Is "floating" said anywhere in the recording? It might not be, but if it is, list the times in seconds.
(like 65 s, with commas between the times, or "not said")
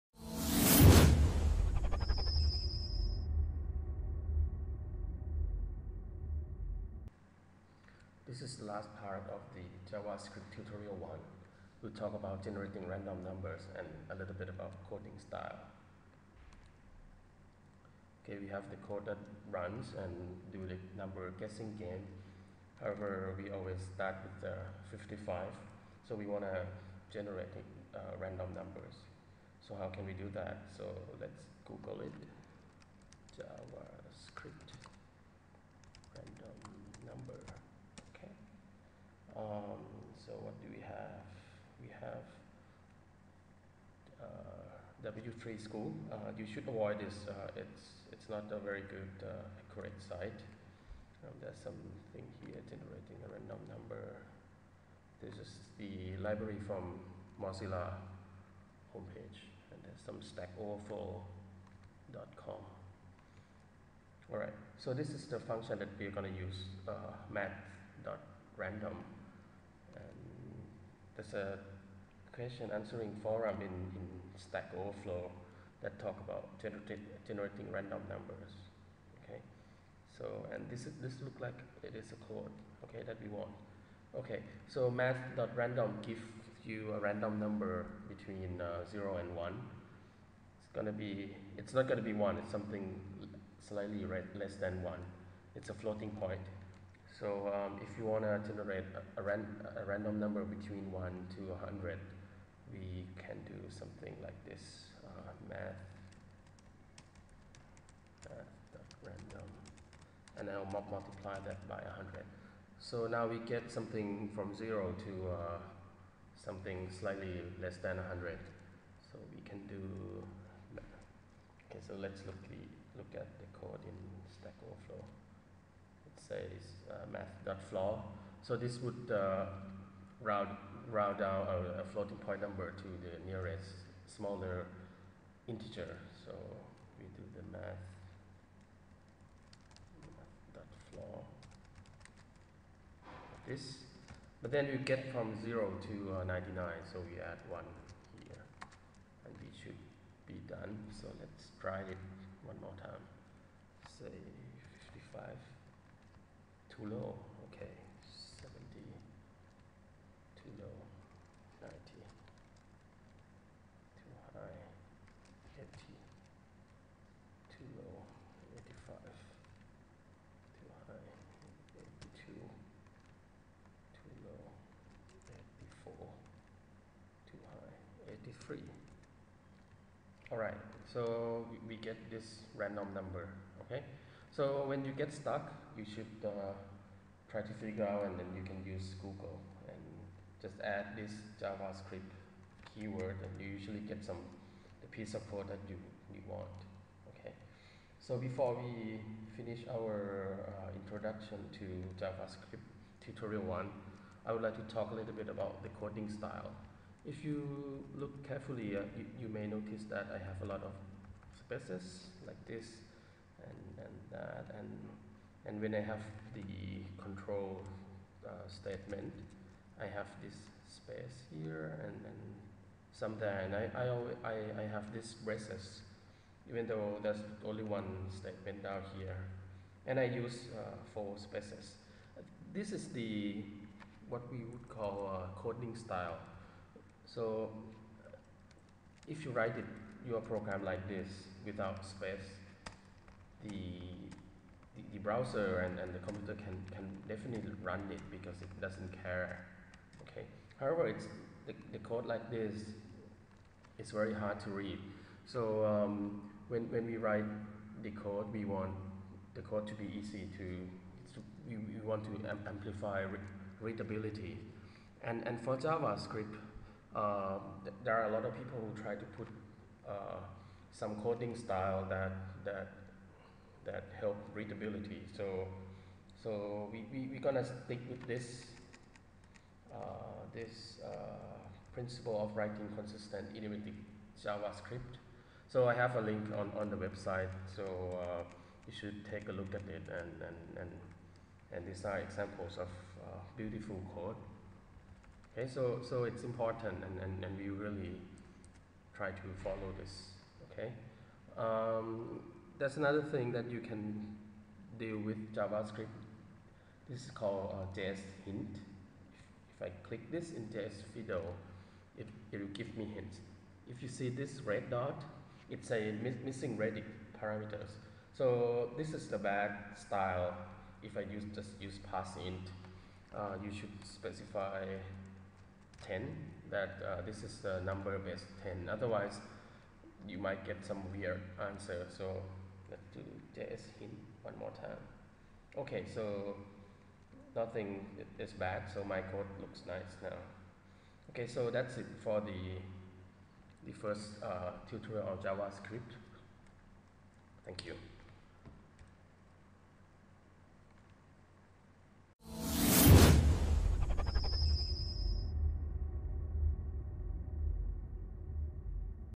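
95 s, 131 s.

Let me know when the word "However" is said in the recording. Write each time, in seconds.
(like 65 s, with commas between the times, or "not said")
22 s, 250 s.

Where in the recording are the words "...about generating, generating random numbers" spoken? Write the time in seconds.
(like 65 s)
76 s.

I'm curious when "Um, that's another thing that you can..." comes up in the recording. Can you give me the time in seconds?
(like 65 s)
301 s.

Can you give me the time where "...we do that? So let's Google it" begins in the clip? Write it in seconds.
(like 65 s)
30 s.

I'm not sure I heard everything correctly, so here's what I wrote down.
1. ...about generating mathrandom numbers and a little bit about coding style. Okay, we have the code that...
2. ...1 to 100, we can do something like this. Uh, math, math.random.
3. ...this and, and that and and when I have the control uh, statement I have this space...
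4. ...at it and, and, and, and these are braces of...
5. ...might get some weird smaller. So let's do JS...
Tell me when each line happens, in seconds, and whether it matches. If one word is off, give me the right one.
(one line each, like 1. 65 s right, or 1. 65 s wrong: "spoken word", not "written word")
1. 12 s wrong: "random", not "mathrandom"
2. 100 s right
3. 212 s right
4. 289 s wrong: "examples", not "braces"
5. 330 s wrong: "answer", not "smaller".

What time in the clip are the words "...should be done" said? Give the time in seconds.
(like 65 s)
149 s.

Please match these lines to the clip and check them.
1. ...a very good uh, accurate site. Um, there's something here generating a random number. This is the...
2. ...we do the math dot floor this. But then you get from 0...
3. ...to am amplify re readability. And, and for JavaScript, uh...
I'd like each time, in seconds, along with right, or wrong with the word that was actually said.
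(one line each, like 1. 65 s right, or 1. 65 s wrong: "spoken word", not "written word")
1. 48 s right
2. 136 s right
3. 262 s right.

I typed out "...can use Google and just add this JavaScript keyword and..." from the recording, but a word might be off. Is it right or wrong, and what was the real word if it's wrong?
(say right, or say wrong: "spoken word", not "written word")
right.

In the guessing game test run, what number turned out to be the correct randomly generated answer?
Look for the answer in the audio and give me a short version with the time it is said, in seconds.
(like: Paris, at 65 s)
83, at 178 s.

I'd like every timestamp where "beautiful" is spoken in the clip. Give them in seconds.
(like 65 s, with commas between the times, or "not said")
293 s.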